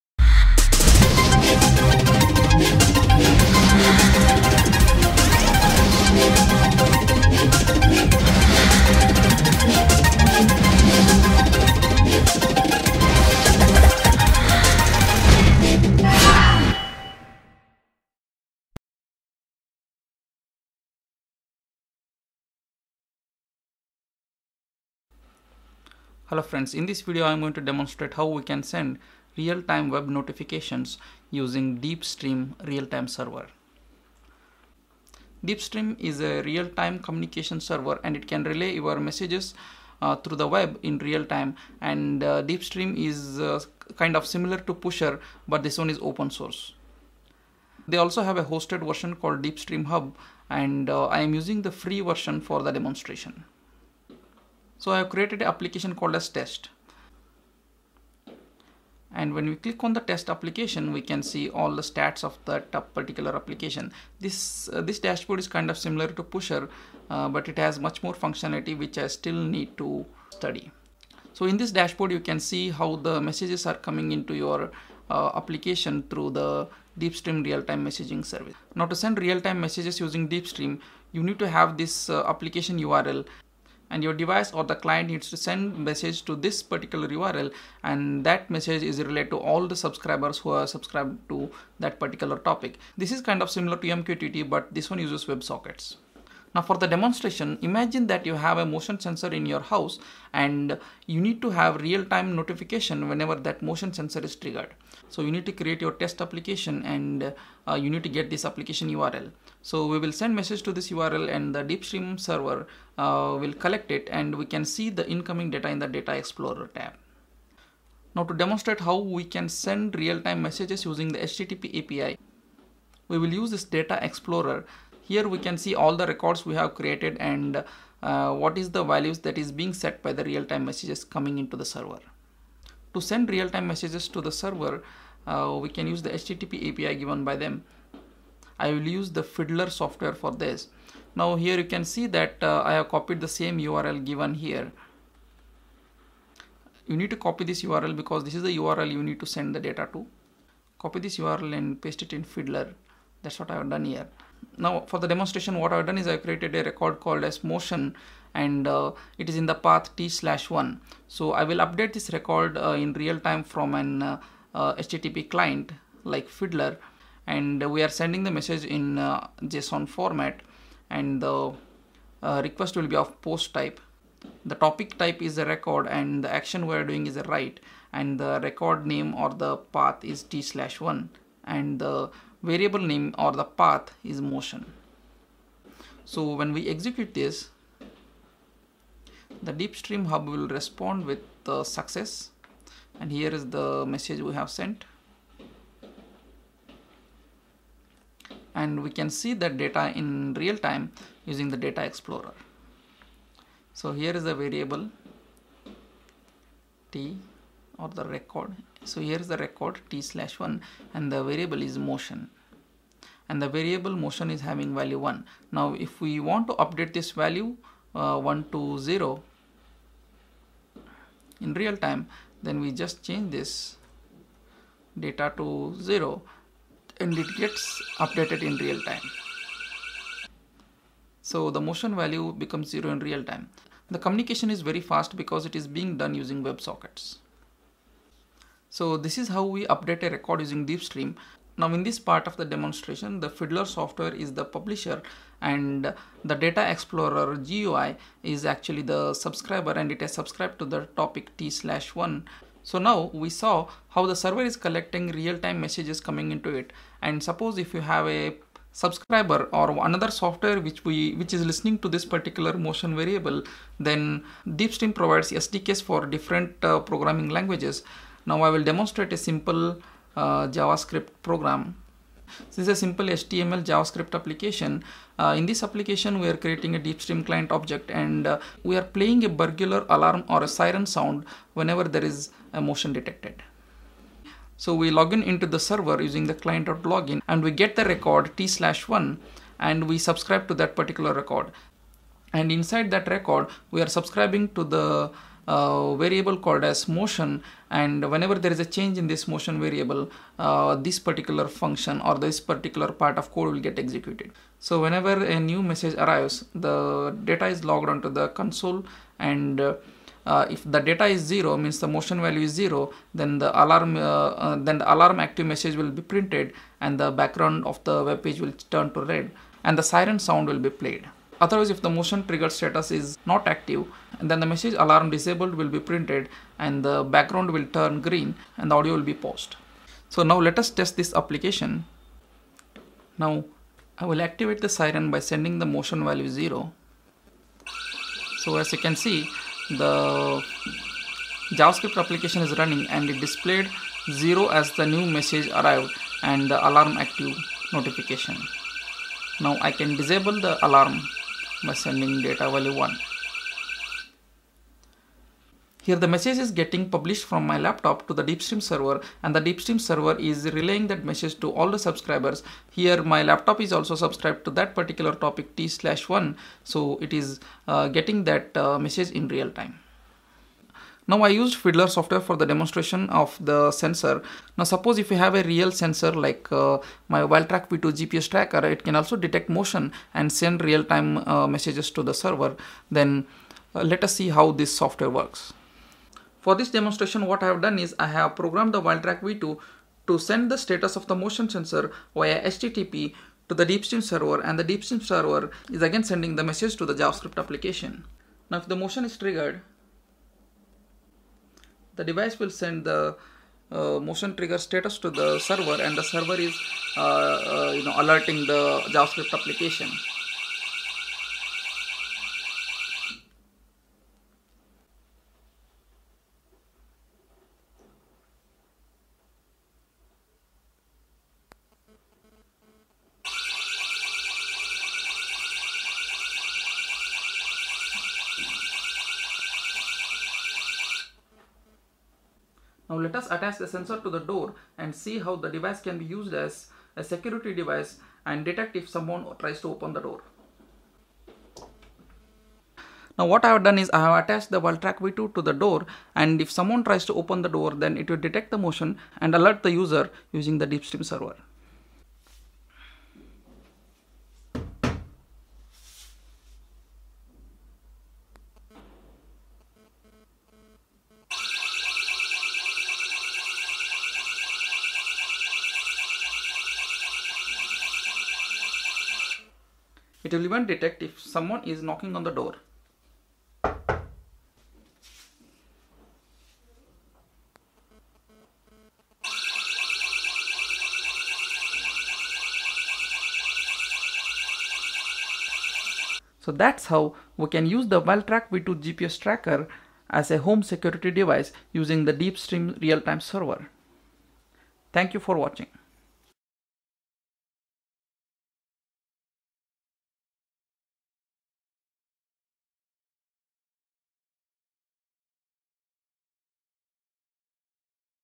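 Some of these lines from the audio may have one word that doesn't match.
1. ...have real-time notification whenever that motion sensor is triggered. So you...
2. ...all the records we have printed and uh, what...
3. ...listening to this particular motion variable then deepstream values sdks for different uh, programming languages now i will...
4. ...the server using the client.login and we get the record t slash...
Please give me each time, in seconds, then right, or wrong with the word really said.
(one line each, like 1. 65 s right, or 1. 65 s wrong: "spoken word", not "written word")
1. 101 s right
2. 125 s wrong: "created", not "printed"
3. 261 s wrong: "provides", not "values"
4. 285 s right.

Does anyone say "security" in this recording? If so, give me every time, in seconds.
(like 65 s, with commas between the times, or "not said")
437 s, 490 s.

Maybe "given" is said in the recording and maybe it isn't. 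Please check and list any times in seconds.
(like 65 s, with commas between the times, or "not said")
136 s, 144 s.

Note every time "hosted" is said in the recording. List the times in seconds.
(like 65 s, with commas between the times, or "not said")
48 s.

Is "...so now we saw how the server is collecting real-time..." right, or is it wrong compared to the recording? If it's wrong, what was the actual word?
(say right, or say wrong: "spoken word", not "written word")
right.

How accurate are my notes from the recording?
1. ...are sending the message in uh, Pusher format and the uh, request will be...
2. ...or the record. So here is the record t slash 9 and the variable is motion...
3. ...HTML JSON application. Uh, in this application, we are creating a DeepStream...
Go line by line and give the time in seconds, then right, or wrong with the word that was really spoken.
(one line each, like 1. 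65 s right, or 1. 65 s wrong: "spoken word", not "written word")
1. 167 s wrong: "JSON", not "Pusher"
2. 207 s wrong: "1", not "9"
3. 273 s wrong: "JavaScript", not "JSON".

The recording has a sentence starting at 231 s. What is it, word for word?
So the motion value becomes zero in real time.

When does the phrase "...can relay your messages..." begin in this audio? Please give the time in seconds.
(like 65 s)
38 s.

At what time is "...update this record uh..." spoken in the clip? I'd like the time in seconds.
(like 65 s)
161 s.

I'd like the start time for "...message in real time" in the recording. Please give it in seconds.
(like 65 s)
368 s.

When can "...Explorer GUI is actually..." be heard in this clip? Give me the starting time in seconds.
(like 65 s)
246 s.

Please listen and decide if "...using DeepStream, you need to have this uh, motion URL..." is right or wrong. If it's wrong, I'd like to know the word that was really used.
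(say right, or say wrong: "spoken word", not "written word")
wrong: "application", not "motion".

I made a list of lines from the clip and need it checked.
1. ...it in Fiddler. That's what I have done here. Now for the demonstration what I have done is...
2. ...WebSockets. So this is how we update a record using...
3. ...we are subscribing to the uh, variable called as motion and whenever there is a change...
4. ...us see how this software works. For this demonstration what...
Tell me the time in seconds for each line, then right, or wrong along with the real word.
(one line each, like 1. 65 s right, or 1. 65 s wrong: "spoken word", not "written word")
1. 152 s right
2. 236 s right
3. 293 s right
4. 384 s right.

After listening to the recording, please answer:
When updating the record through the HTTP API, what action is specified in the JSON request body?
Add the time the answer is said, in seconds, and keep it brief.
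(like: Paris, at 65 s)
write, at 177 s.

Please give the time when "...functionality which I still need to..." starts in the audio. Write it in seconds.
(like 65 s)
68 s.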